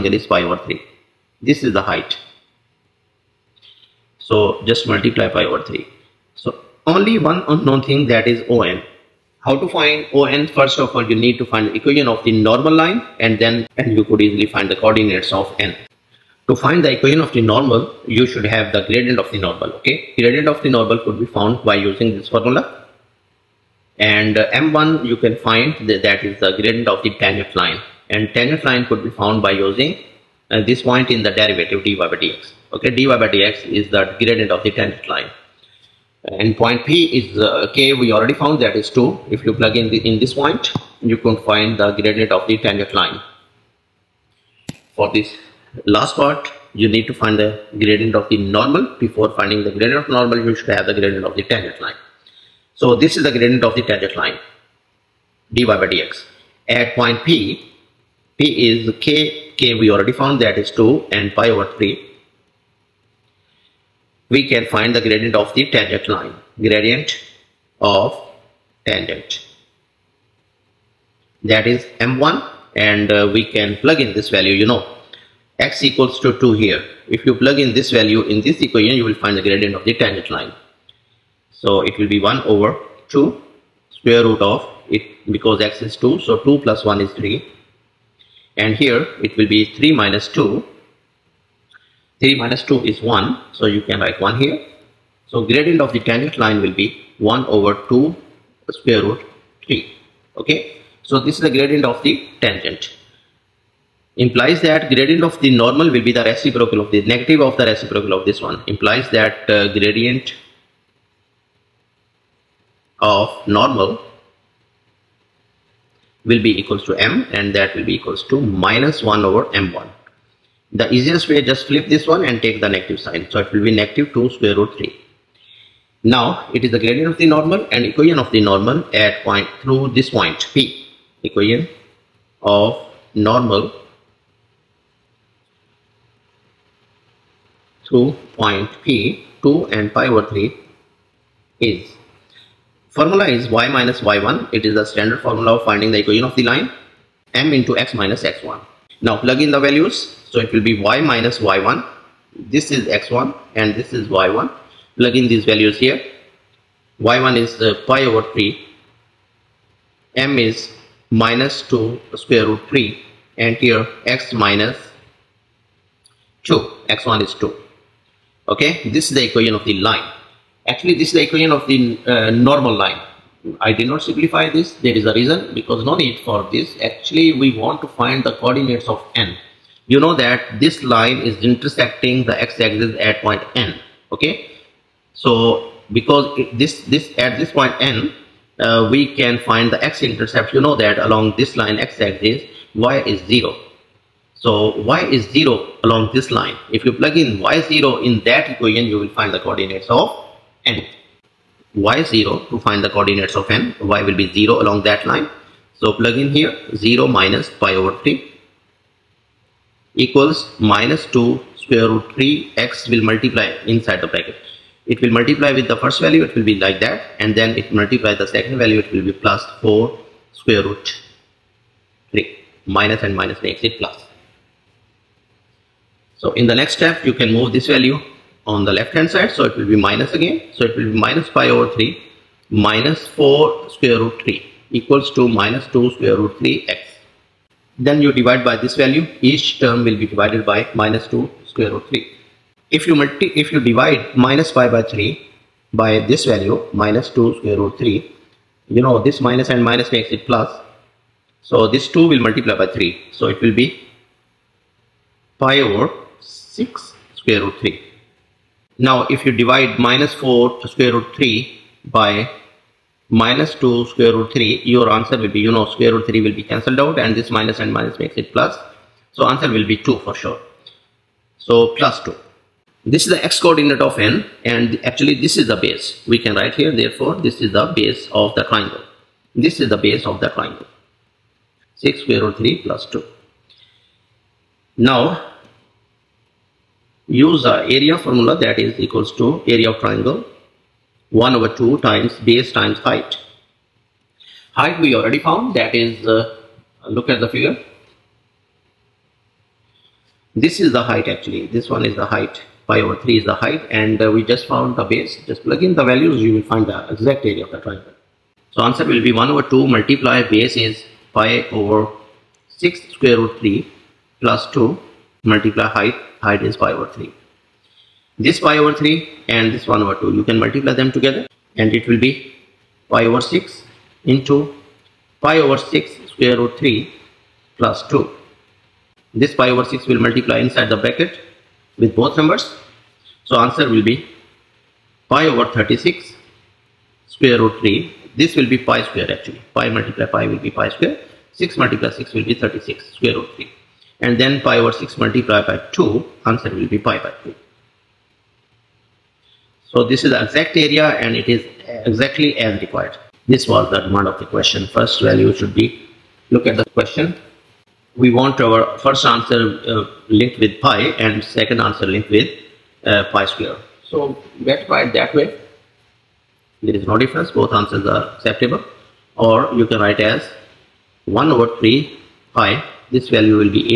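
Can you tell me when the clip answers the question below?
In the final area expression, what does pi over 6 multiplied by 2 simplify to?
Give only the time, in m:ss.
5:46.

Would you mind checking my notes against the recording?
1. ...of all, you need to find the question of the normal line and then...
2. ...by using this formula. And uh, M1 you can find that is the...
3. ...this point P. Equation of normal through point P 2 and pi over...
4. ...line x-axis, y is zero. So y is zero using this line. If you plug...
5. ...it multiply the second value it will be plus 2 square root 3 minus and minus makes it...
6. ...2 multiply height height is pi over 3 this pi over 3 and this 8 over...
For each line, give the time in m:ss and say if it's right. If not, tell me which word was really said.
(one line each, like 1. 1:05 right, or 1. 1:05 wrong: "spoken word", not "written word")
1. 0:10 wrong: "equation", not "question"
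2. 0:21 right
3. 2:09 right
4. 3:11 wrong: "along", not "using"
5. 3:37 wrong: "4", not "2"
6. 5:14 wrong: "1", not "8".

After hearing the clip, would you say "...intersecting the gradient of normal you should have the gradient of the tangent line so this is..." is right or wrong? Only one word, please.
wrong.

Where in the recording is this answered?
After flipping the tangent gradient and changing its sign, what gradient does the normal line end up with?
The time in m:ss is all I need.
2:03.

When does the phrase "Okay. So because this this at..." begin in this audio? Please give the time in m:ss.
3:04.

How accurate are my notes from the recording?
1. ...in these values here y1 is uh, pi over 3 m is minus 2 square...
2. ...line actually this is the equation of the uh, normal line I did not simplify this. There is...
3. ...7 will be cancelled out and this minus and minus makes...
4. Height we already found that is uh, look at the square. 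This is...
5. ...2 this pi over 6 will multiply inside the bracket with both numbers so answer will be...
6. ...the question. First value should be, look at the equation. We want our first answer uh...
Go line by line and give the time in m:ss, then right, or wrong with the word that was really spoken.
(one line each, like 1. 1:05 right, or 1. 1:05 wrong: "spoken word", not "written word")
1. 2:35 right
2. 2:49 right
3. 4:26 wrong: "3", not "7"
4. 4:54 wrong: "figure", not "square"
5. 5:27 right
6. 5:54 wrong: "question", not "equation".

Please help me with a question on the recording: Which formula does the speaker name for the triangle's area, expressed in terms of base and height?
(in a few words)
1/2 times base times height.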